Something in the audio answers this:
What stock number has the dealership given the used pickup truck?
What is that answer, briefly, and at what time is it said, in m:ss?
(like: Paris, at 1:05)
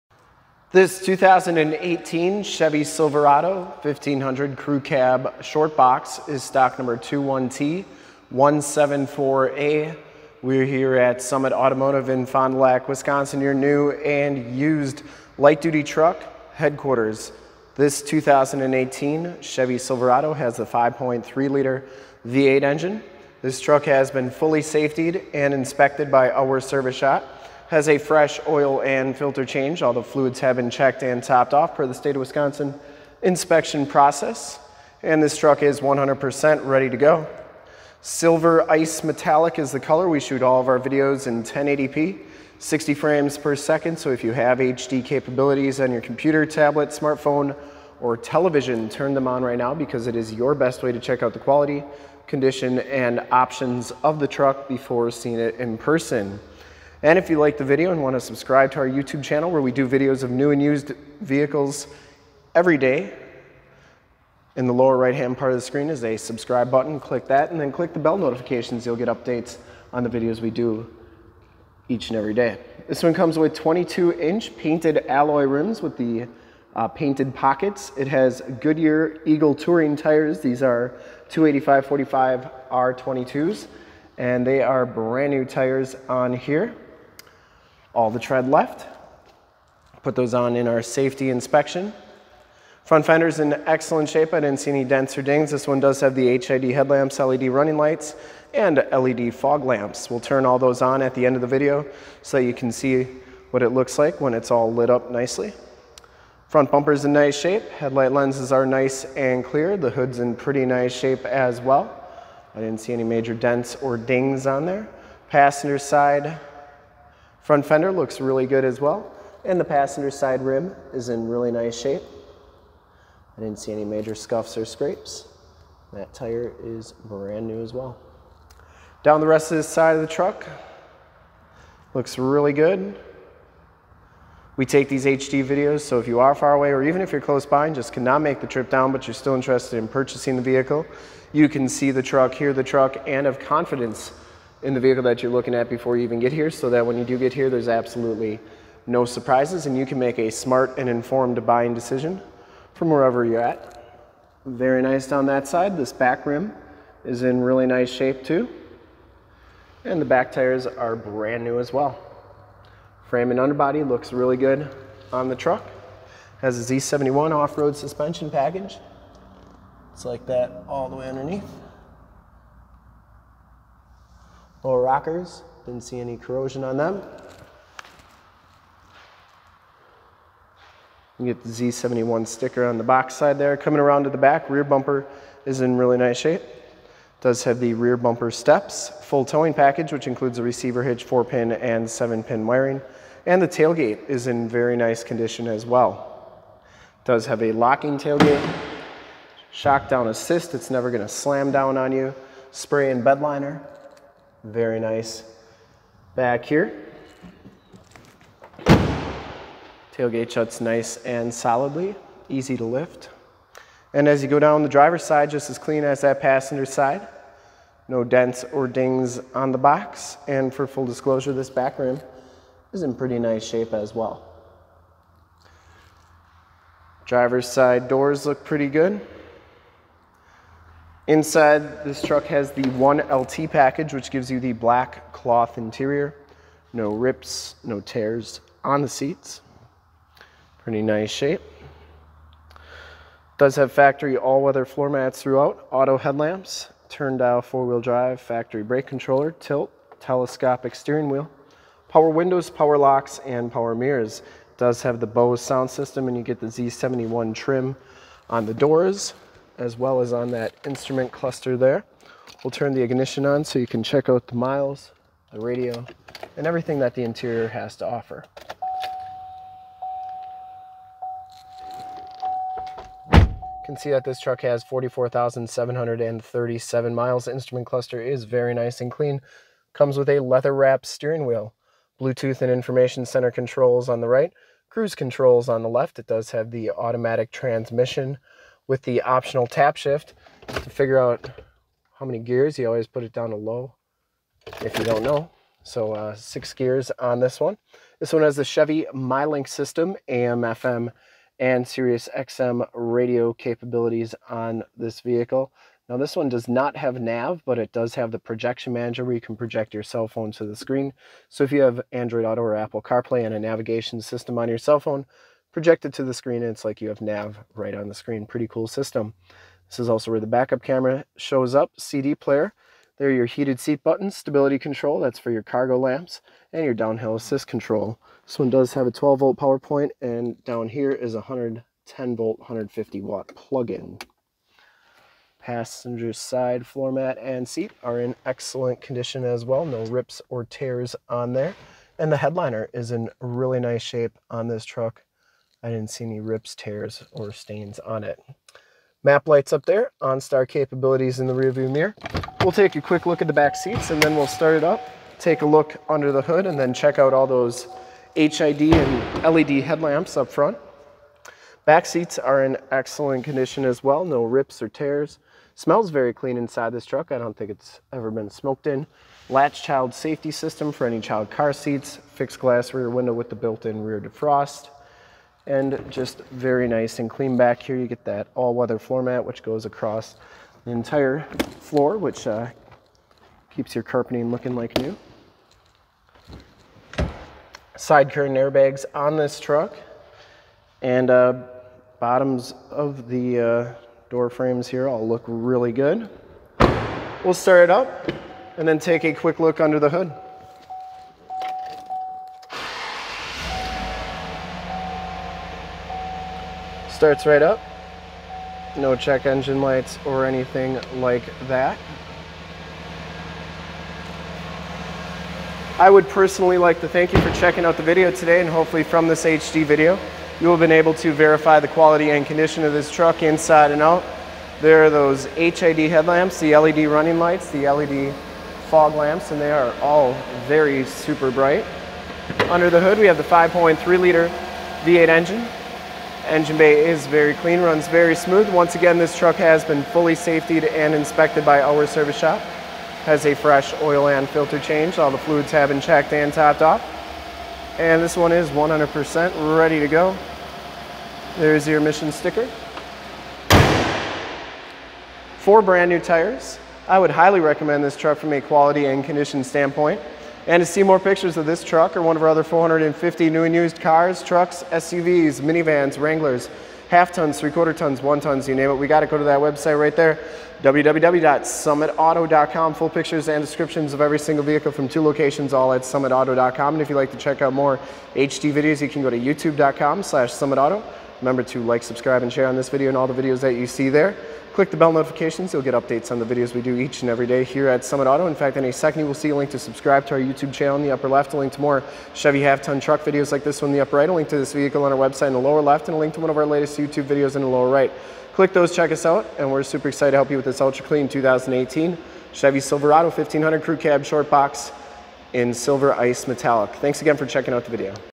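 21T174A, at 0:06.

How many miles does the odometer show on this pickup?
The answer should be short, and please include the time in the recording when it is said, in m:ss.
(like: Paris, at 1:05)
44,737, at 4:34.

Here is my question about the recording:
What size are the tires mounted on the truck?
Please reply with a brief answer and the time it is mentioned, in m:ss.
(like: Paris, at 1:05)
285-45 R22, at 1:21.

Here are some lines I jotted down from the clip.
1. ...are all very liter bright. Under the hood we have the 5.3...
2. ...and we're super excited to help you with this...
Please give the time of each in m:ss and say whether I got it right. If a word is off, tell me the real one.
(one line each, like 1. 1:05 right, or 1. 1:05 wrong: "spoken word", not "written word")
1. 7:09 wrong: "super", not "liter"
2. 8:19 right.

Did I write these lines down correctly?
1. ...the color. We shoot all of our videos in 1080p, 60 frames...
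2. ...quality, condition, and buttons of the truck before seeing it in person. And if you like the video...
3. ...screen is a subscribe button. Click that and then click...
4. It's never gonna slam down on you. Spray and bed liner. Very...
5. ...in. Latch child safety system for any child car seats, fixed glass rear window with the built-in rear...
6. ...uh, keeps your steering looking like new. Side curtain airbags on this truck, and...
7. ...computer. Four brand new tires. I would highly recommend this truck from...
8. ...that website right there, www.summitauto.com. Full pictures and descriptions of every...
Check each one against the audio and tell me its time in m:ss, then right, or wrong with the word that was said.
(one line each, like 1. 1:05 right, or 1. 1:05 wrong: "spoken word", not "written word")
1. 0:39 right
2. 0:51 wrong: "options", not "buttons"
3. 1:05 right
4. 3:20 right
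5. 6:08 right
6. 6:22 wrong: "carpeting", not "steering"
7. 7:32 wrong: "sticker", not "computer"
8. 7:49 right.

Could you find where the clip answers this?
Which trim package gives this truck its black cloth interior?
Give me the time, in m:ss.
3:52.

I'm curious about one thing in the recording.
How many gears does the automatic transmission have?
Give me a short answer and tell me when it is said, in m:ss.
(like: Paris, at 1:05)
6, at 4:56.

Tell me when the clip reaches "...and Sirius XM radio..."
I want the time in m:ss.
5:01.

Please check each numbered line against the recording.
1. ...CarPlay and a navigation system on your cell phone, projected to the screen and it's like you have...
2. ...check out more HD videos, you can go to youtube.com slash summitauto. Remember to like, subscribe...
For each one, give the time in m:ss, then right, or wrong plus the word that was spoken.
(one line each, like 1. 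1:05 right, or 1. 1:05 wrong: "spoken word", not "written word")
1. 5:12 right
2. 7:57 right.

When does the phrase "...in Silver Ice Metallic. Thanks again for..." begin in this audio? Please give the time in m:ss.
8:25.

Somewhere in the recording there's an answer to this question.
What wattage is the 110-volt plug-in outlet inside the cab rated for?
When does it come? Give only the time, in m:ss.
5:32.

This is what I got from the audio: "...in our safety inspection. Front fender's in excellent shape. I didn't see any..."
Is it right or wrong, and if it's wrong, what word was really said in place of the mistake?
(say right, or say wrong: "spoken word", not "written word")
right.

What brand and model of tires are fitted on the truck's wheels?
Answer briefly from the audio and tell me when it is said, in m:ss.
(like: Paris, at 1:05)
Goodyear Eagle Touring, at 1:18.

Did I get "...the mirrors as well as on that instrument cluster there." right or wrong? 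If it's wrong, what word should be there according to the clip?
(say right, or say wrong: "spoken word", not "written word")
wrong: "doors", not "mirrors".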